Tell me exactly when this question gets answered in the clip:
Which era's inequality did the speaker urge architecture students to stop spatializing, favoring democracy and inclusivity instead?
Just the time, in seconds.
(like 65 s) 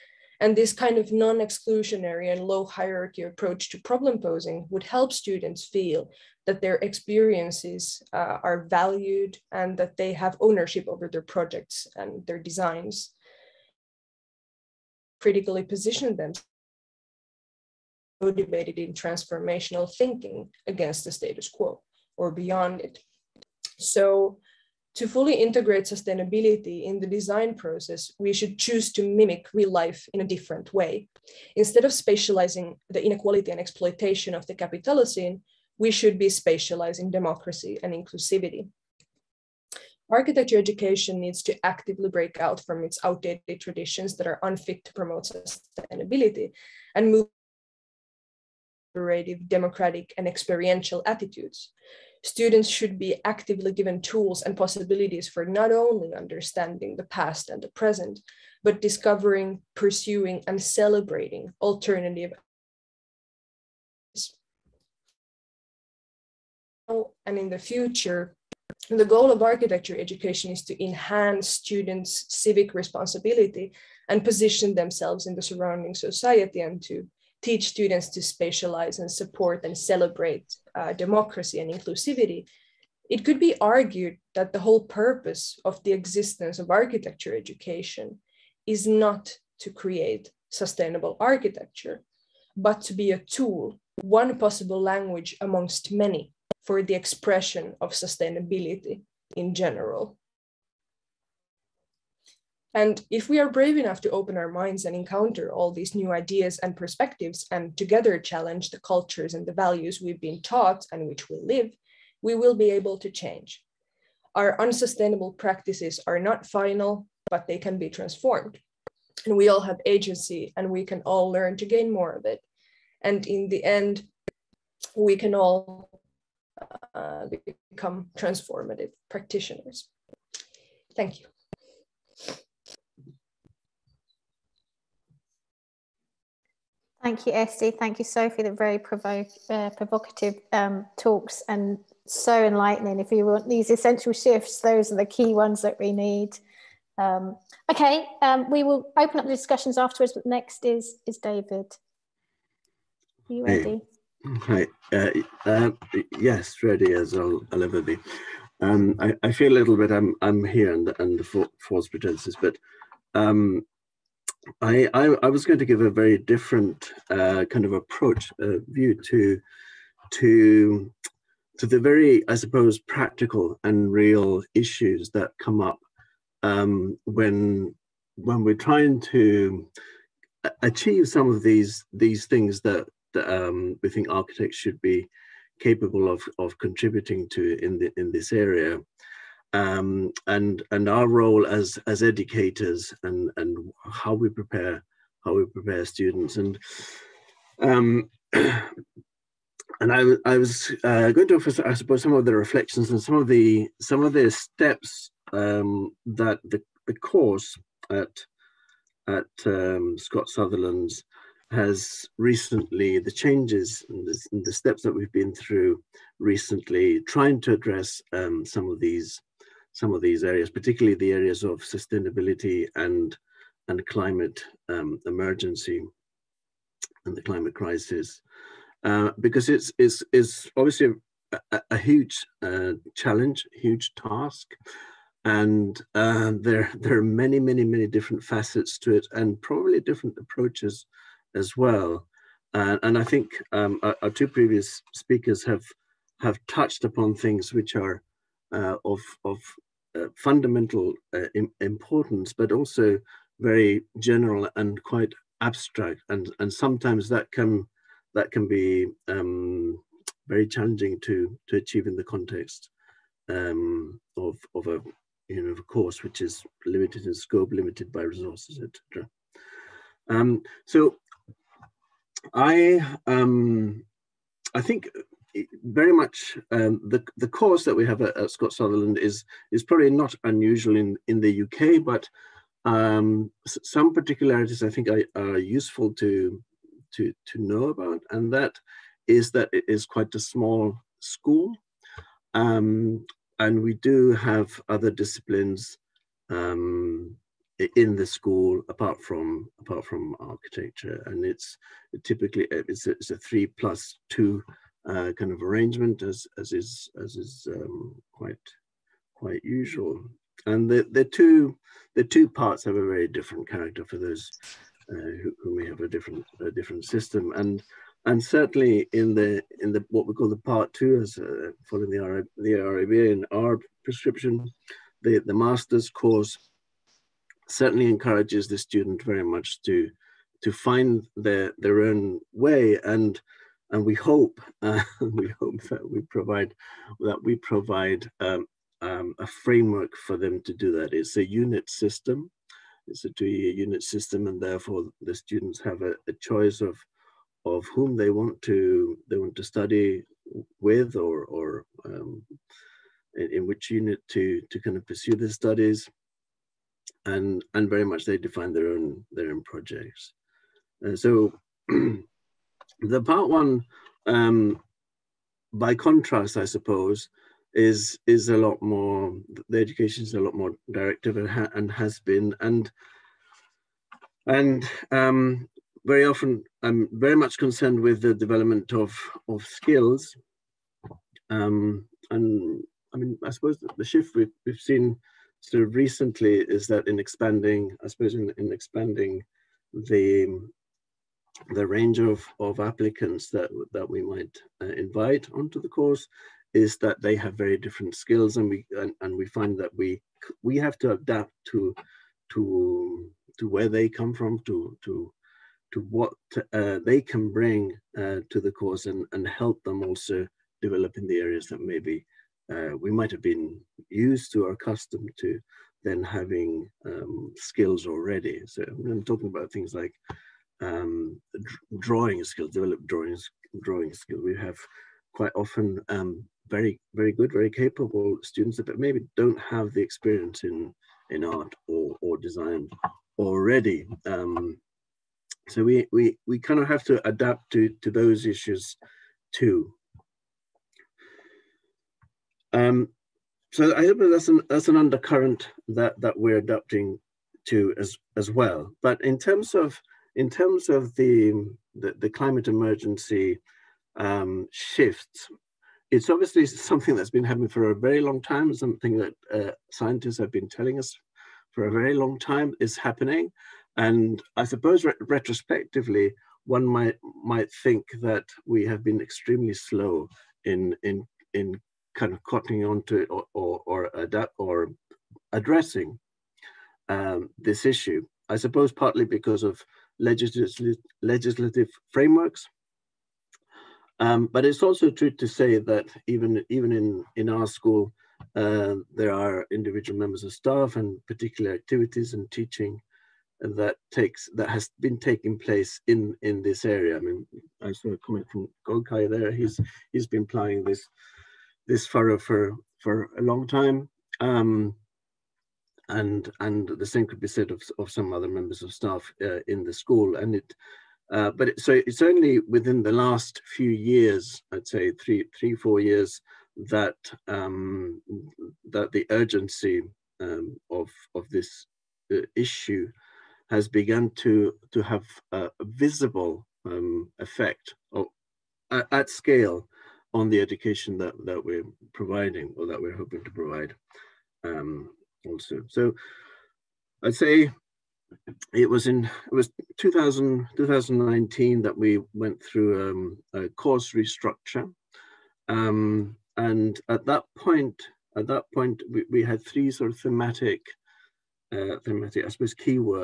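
34 s.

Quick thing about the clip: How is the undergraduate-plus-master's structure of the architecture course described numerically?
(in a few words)
3 plus 2.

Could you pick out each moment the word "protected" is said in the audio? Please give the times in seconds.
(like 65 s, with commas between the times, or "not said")
not said.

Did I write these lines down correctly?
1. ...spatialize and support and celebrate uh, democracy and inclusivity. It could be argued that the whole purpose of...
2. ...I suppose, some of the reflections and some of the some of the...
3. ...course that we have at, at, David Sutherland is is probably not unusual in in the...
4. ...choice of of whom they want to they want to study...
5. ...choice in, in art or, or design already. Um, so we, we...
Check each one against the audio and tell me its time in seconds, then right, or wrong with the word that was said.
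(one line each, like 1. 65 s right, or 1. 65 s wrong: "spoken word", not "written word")
1. 78 s right
2. 201 s right
3. 277 s wrong: "Scott", not "David"
4. 346 s right
5. 429 s wrong: "experience", not "choice".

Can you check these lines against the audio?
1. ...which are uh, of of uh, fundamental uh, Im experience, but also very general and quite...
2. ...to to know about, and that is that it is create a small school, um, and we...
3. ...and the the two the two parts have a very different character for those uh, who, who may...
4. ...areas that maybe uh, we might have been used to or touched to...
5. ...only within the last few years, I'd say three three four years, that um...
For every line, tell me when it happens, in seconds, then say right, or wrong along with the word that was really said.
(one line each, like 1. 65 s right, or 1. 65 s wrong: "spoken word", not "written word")
1. 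247 s wrong: "importance", not "experience"
2. 286 s wrong: "quite", not "create"
3. 310 s right
4. 411 s wrong: "accustomed", not "touched"
5. 512 s right.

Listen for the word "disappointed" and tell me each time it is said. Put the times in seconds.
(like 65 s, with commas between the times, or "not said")
not said.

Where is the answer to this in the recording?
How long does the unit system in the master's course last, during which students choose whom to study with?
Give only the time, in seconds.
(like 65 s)
343 s.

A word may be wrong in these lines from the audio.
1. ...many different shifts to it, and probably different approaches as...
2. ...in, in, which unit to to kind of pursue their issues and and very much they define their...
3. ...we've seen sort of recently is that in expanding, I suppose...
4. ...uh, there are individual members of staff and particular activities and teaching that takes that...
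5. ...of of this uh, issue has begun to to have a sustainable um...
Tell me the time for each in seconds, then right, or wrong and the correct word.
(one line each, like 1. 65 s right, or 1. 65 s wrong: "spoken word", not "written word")
1. 237 s wrong: "facets", not "shifts"
2. 353 s wrong: "studies", not "issues"
3. 384 s right
4. 488 s right
5. 520 s wrong: "visible", not "sustainable".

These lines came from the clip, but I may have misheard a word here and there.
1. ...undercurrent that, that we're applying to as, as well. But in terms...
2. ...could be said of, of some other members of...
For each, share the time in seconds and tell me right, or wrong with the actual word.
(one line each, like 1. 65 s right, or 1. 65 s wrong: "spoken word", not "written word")
1. 444 s wrong: "adapting", not "applying"
2. 507 s right.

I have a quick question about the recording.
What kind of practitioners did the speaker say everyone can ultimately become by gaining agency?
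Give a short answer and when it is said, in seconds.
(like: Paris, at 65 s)
Transformative practitioners, at 128 s.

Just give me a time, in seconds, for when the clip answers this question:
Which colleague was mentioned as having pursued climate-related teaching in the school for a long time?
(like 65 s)
498 s.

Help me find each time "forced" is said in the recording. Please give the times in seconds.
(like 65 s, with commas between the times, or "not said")
not said.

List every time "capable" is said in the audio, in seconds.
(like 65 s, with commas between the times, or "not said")
185 s, 427 s.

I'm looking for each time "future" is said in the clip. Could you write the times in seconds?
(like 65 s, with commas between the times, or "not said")
67 s.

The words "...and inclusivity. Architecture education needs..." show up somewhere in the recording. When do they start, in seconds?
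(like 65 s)
37 s.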